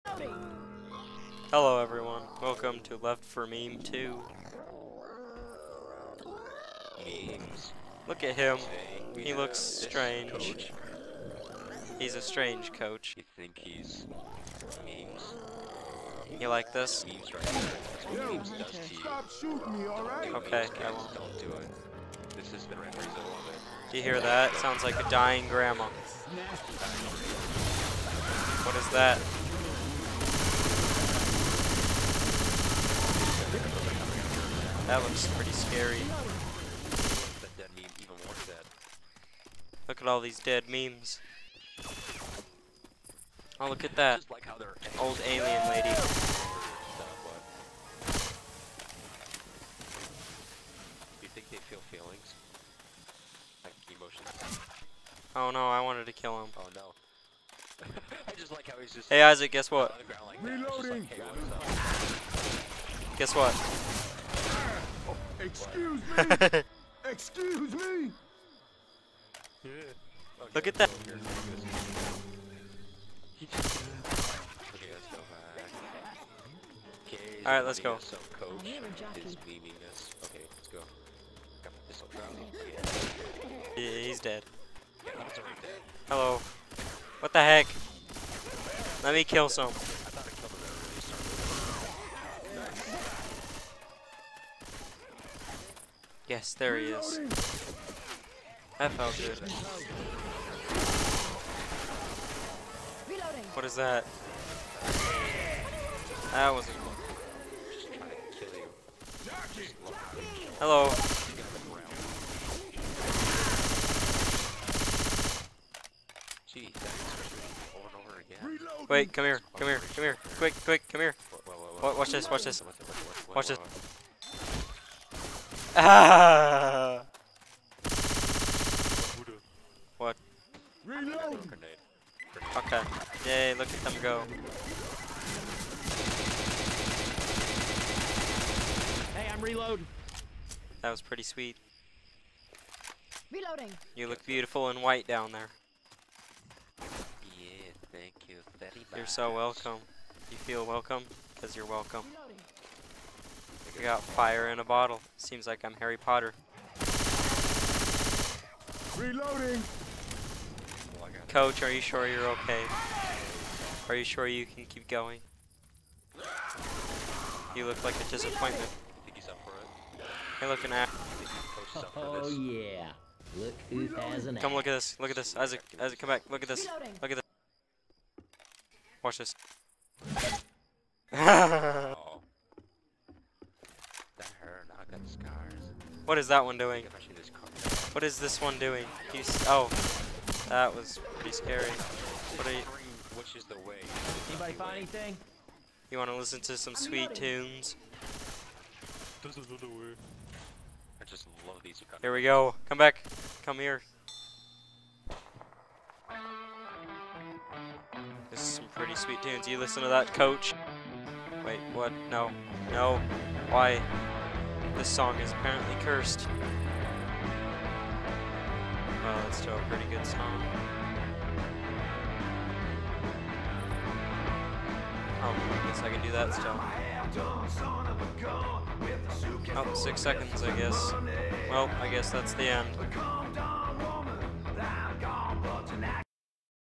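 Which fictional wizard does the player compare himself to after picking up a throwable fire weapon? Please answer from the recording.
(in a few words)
Harry Potter.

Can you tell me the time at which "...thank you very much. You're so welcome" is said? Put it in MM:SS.
02:27.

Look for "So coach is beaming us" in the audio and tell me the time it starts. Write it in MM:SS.
01:17.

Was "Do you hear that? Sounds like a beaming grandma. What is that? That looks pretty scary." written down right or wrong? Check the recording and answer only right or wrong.
wrong.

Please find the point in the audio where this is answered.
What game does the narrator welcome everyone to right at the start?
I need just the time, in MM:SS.
00:02.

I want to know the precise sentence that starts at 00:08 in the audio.
Look at him, he looks strange.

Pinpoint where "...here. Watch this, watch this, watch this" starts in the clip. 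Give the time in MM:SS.
02:01.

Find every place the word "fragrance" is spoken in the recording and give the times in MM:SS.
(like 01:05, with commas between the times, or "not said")
not said.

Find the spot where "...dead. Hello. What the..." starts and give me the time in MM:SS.
01:24.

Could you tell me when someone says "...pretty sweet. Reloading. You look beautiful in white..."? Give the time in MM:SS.
02:21.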